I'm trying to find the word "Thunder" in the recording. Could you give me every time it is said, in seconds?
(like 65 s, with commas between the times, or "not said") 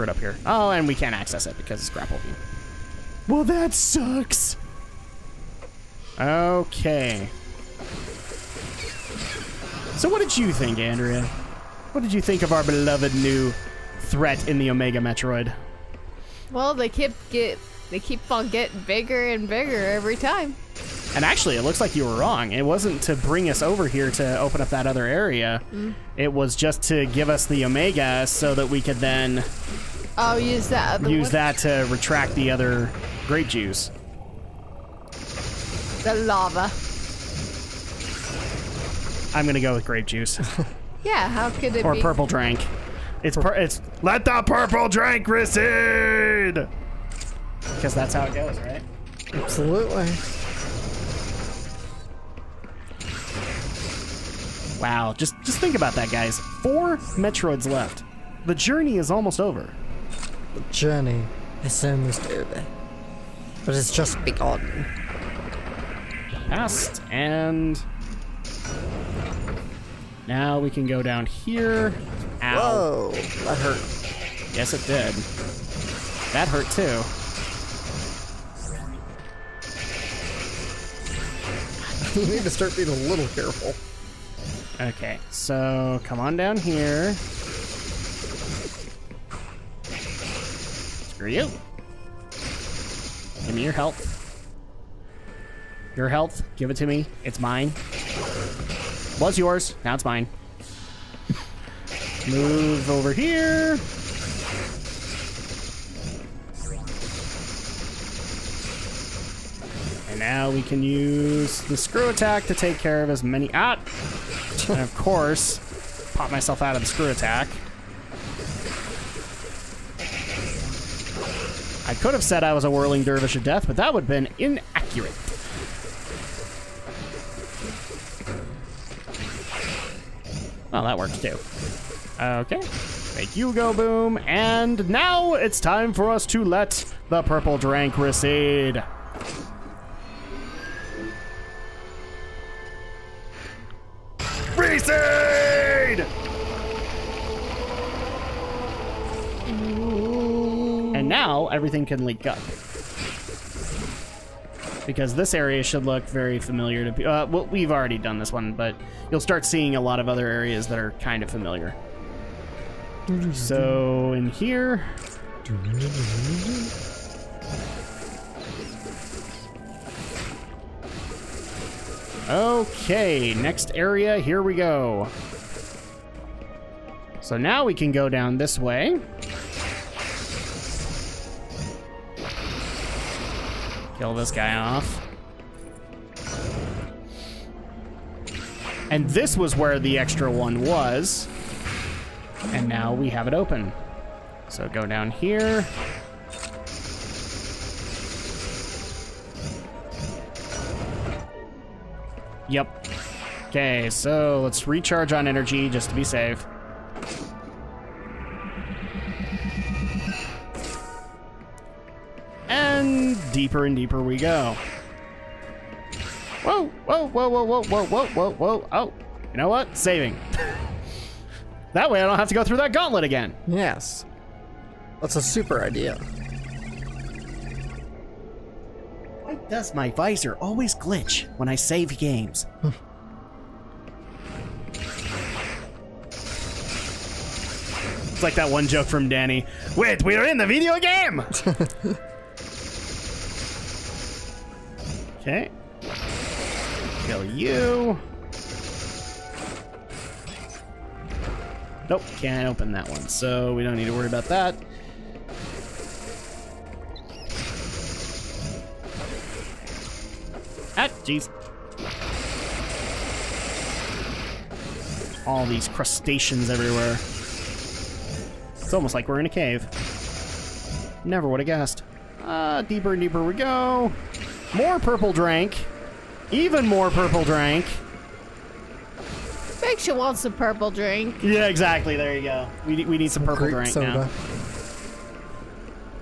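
not said.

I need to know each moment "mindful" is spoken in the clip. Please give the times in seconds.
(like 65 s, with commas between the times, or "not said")
not said.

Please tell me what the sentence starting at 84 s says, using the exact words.
Okay, so come on down here.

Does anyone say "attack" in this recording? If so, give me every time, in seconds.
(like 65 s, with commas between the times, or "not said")
112 s, 117 s.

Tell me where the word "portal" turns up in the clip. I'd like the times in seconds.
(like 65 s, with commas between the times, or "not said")
not said.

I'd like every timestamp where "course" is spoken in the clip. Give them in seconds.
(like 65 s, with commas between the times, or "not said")
114 s.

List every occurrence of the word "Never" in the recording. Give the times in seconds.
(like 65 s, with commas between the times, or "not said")
271 s.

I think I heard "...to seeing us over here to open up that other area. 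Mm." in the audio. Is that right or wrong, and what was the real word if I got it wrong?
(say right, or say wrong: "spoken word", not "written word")
wrong: "bring", not "seeing".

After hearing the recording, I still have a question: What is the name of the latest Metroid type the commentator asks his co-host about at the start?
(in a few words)
Omega Metroid.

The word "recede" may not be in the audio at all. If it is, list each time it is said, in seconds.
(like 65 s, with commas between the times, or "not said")
45 s, 137 s, 144 s.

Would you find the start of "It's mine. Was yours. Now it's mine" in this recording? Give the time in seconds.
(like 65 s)
97 s.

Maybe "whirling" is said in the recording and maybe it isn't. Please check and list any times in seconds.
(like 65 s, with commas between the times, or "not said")
122 s.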